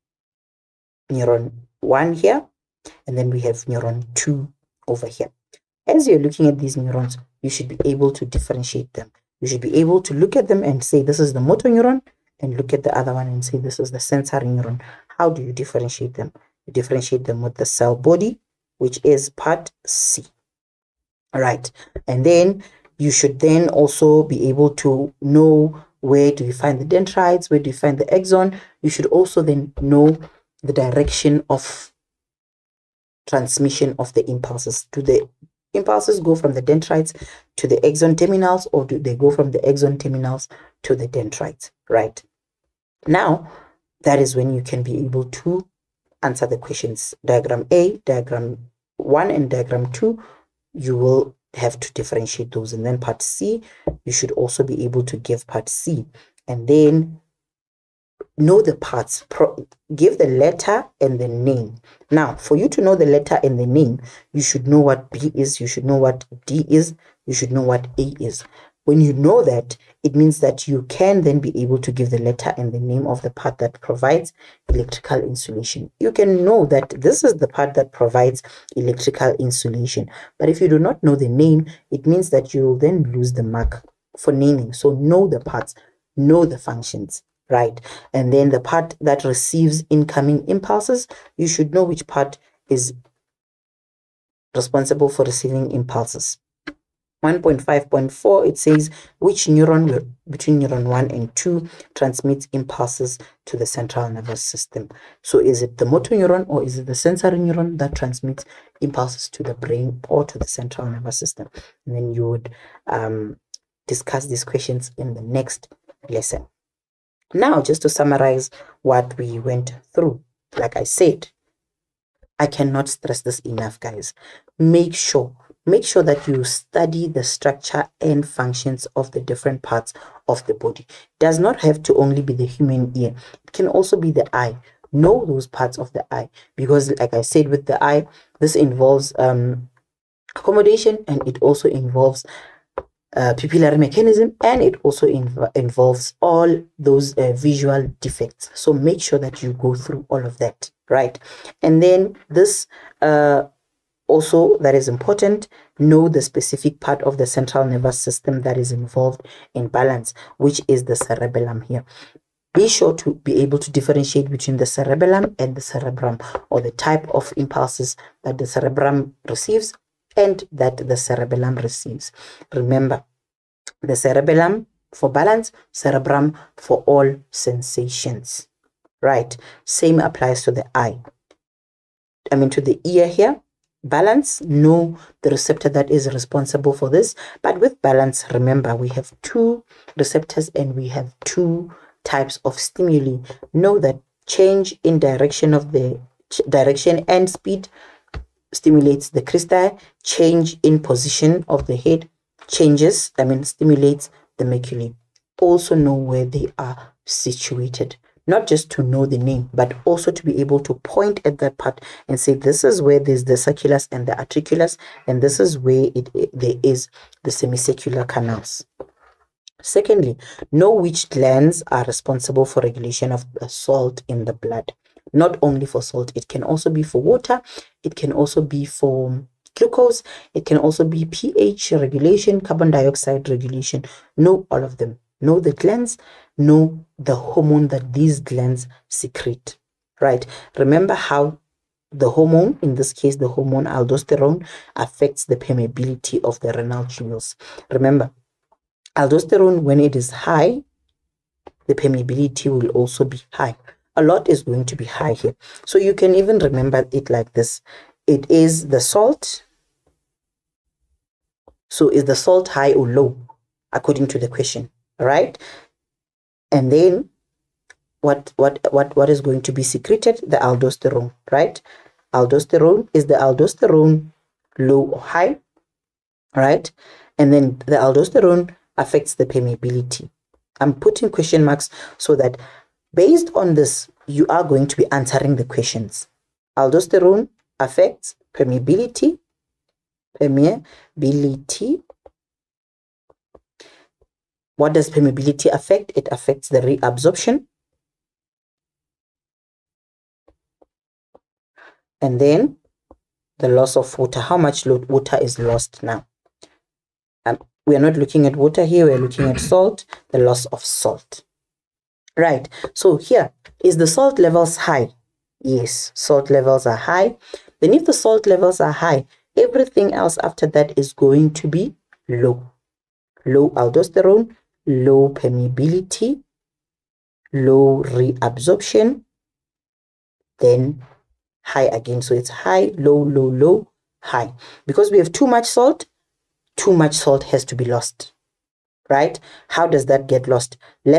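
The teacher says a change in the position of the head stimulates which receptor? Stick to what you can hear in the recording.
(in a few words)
Macula.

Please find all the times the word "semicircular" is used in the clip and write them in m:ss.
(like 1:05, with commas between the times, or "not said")
3:37.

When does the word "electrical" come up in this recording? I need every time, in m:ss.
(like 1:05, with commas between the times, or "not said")
1:14, 1:18.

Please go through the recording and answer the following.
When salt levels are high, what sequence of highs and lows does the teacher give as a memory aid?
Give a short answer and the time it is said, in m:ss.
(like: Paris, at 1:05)
High, low, low, low, high, at 5:32.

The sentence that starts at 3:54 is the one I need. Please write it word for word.
Know all of them know the glands, know the hormone that these glands secrete, right?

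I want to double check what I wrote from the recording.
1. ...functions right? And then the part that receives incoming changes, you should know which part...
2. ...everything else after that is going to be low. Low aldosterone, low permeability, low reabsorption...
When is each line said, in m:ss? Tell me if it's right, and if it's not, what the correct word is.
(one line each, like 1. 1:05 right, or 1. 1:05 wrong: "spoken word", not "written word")
1. 1:26 wrong: "impulses", not "changes"
2. 5:19 right.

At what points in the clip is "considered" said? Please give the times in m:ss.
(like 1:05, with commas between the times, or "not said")
not said.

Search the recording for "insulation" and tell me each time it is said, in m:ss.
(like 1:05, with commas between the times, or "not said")
1:15, 1:19.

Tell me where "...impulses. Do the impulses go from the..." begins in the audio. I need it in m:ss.
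0:34.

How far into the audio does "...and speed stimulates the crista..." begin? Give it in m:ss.
3:17.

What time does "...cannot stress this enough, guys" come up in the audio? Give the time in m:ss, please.
2:02.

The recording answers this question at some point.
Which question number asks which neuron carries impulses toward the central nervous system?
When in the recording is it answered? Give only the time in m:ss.
1:37.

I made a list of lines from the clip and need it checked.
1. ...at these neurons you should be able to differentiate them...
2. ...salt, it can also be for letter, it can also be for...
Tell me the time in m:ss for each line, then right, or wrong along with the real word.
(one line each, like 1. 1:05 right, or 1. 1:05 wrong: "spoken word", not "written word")
1. 0:06 right
2. 3:45 wrong: "water", not "letter".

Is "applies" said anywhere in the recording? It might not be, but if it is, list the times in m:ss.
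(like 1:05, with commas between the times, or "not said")
3:00.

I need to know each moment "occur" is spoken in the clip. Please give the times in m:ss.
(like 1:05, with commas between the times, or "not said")
not said.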